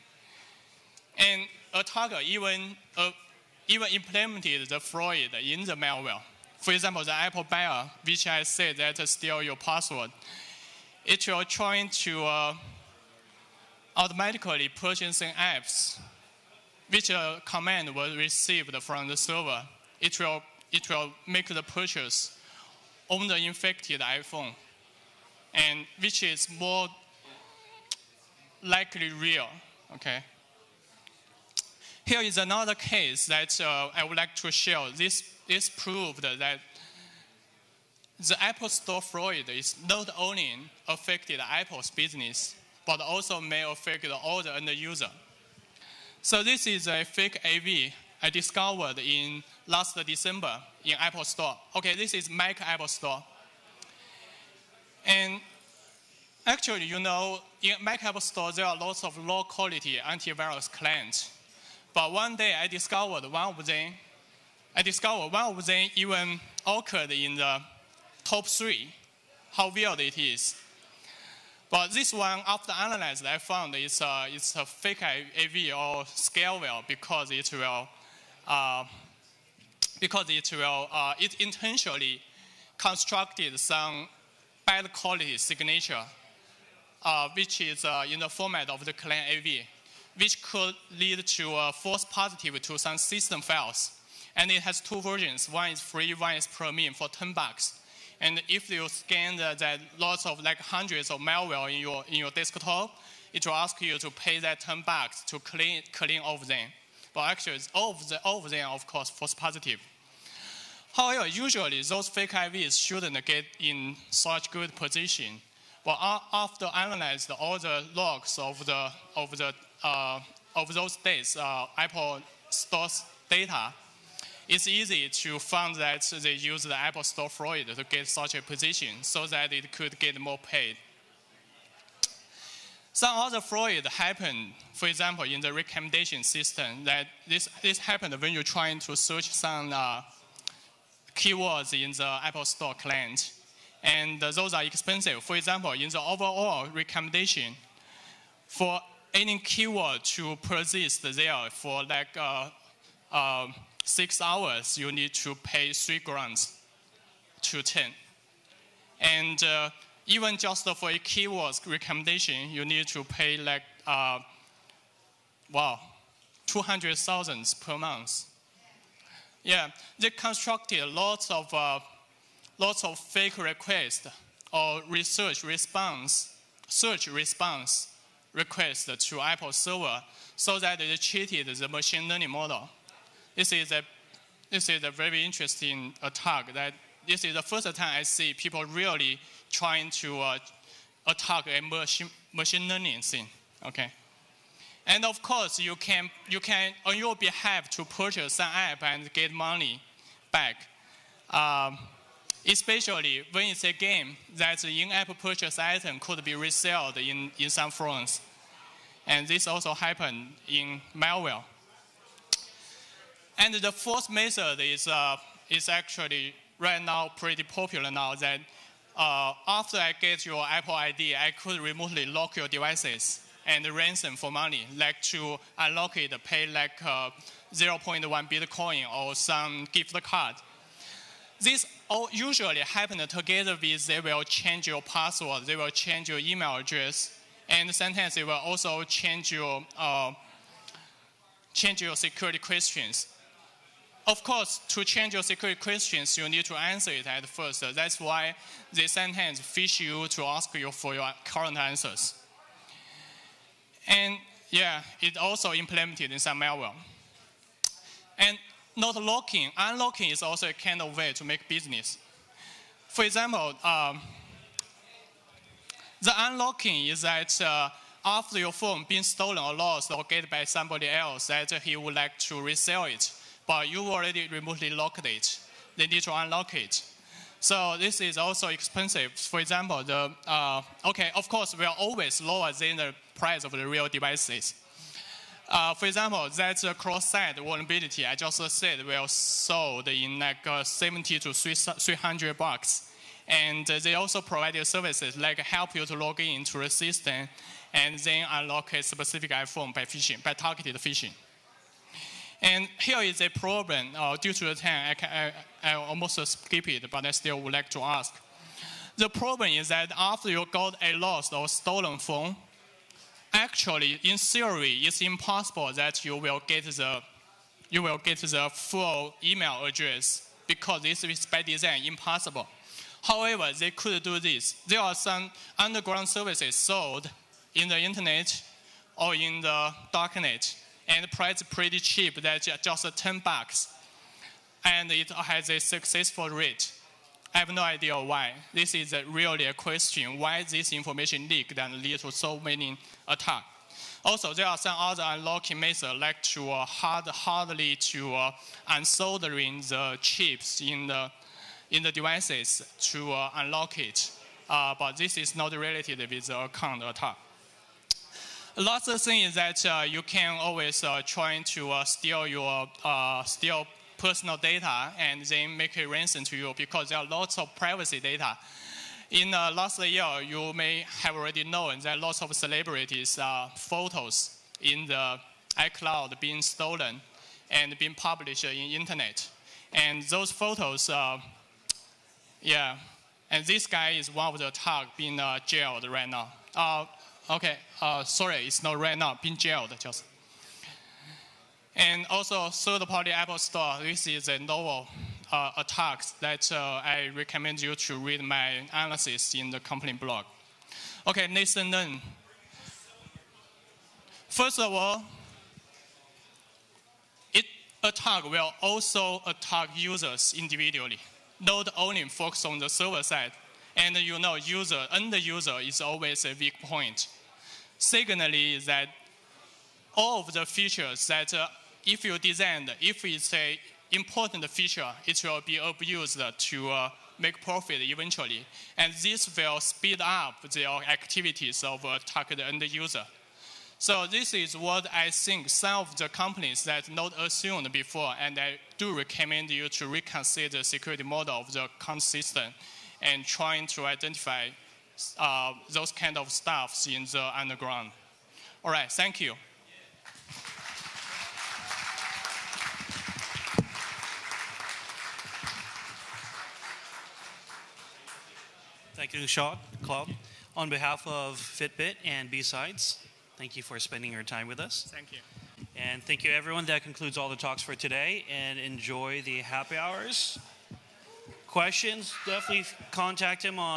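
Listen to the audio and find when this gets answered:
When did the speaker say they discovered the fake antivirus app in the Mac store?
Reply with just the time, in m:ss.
0:49.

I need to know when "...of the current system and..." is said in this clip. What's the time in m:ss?
7:21.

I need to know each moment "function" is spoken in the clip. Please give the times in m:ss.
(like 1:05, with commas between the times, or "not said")
not said.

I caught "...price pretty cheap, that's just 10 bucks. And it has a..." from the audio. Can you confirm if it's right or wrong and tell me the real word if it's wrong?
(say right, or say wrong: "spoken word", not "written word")
right.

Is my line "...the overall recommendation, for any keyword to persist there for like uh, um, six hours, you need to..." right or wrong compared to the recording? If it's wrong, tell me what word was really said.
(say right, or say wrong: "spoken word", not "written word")
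right.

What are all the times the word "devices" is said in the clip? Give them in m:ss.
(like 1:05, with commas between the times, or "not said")
3:42, 4:43, 5:51.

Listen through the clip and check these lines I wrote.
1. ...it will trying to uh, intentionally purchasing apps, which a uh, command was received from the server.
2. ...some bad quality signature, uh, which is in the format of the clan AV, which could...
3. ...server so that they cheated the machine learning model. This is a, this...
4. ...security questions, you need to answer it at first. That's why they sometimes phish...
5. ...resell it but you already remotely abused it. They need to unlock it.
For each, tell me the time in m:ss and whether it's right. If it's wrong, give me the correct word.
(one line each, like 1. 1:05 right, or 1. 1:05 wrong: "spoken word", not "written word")
1. 0:11 wrong: "automatically", not "intentionally"
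2. 1:23 right
3. 2:59 right
4. 4:05 right
5. 4:32 wrong: "locked", not "abused".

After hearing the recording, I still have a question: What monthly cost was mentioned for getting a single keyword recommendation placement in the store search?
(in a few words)
200,000.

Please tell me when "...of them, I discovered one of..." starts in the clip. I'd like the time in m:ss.
1:03.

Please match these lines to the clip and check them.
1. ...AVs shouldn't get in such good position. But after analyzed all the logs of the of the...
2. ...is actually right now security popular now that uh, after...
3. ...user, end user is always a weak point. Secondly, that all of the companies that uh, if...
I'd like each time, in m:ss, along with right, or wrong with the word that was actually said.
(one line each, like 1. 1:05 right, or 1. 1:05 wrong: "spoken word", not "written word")
1. 1:52 right
2. 3:35 wrong: "pretty", not "security"
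3. 6:54 wrong: "features", not "companies".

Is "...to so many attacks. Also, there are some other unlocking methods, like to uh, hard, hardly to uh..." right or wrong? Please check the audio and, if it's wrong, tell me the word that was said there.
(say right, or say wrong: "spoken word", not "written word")
right.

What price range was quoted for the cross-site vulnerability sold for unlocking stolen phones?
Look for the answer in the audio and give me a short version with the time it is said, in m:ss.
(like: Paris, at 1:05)
70 to 300 bucks, at 4:50.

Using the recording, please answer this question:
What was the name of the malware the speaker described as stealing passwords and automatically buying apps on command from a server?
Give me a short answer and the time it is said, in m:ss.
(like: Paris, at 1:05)
AppBuyer, at 0:07.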